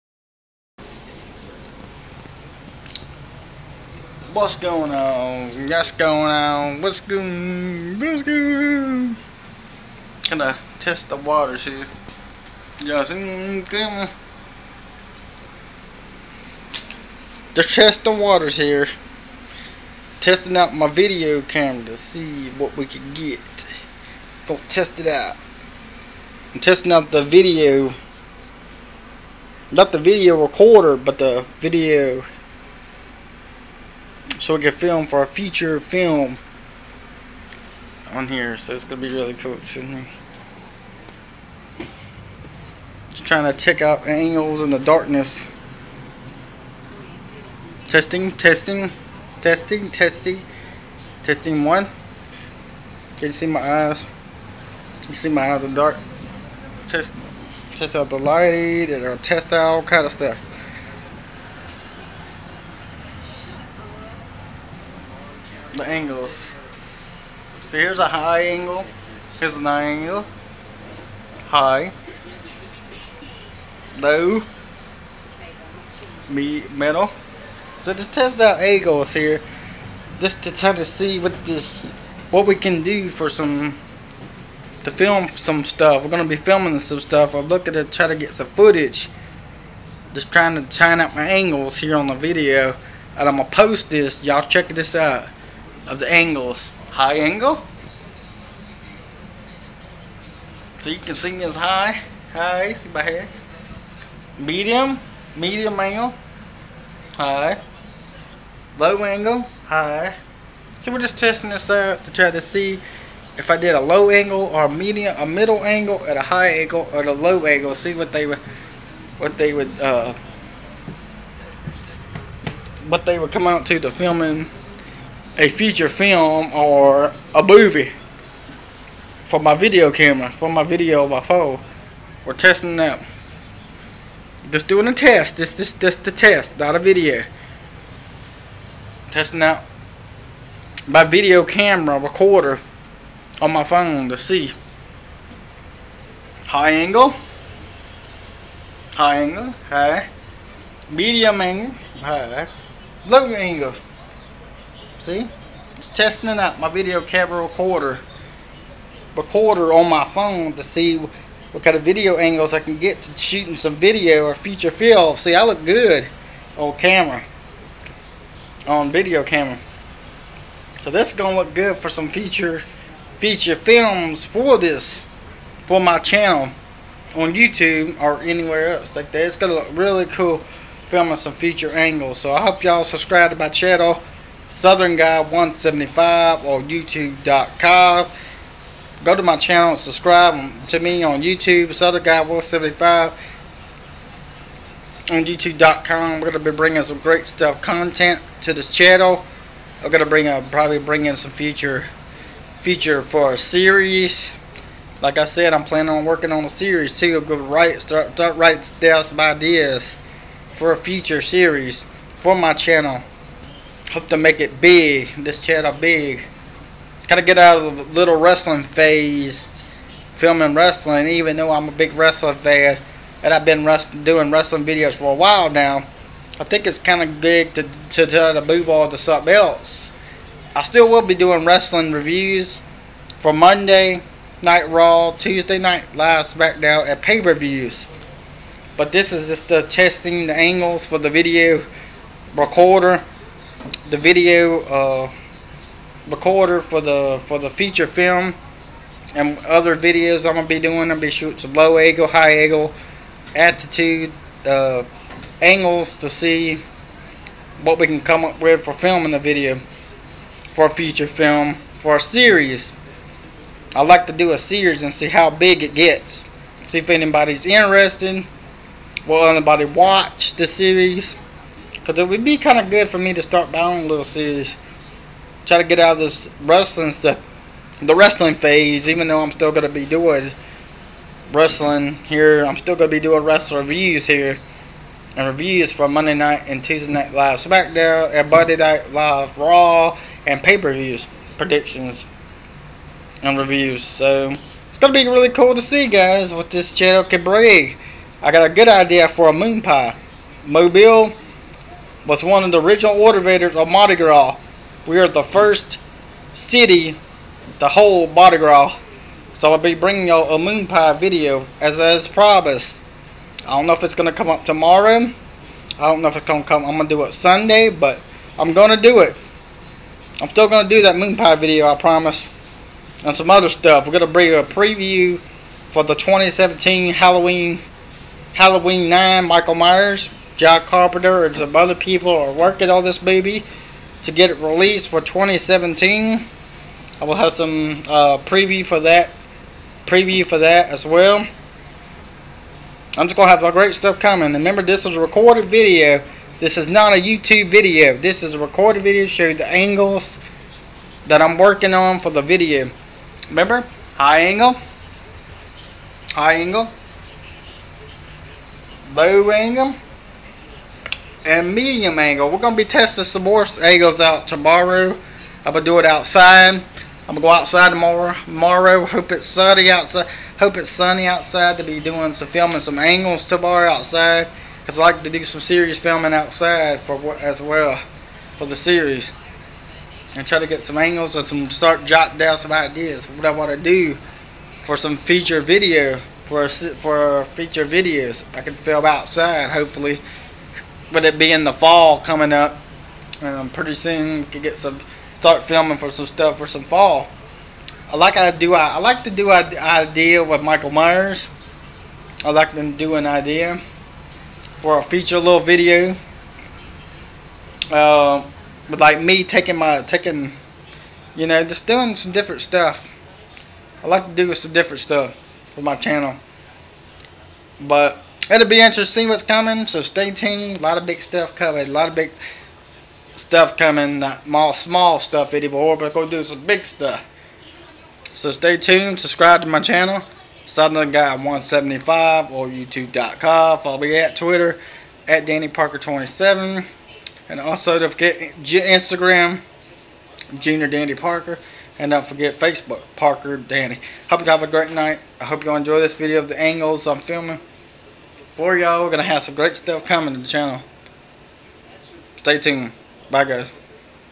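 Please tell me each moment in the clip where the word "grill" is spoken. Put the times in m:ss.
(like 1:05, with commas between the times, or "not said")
not said.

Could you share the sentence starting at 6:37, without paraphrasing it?
I like I do I, I like to do an idea with Michael Myers.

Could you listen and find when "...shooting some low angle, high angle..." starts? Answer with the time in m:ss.
4:11.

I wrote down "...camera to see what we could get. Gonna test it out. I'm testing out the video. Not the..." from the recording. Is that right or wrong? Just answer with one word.
right.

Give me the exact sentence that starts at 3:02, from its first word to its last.
So I hope y'all subscribe to my channel.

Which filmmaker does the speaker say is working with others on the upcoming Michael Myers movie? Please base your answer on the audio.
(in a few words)
Jack Carpenter.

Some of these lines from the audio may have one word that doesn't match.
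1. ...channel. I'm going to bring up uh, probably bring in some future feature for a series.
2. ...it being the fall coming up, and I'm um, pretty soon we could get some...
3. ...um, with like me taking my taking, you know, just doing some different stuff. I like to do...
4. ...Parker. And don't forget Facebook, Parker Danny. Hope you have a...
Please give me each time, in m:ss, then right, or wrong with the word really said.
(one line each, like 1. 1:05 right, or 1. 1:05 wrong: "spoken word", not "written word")
1. 3:18 right
2. 6:31 right
3. 6:48 right
4. 7:20 right.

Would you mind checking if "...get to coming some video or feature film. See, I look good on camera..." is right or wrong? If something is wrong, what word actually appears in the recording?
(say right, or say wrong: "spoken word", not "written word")
wrong: "shooting", not "coming".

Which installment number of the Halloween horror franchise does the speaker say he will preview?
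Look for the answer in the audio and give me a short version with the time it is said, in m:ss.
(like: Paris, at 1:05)
9, at 5:28.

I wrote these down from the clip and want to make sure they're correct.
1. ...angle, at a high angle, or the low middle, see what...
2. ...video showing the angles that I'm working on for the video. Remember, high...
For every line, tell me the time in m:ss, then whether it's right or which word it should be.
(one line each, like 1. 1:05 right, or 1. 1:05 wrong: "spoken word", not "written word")
1. 1:55 wrong: "angle", not "middle"
2. 5:48 right.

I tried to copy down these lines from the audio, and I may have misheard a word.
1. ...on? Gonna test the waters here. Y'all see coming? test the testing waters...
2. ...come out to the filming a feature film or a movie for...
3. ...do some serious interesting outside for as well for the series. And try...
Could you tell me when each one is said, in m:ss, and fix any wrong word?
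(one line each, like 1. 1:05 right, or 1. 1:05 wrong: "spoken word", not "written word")
1. 0:08 right
2. 2:03 right
3. 6:15 wrong: "filming", not "interesting".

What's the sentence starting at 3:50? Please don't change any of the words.
I still will be doing wrestling reviews for Monday Night Raw, Tuesday Night Live SmackDown, and pay-per-views.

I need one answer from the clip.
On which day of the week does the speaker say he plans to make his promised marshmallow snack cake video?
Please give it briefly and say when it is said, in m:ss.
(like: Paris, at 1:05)
Sunday, at 5:17.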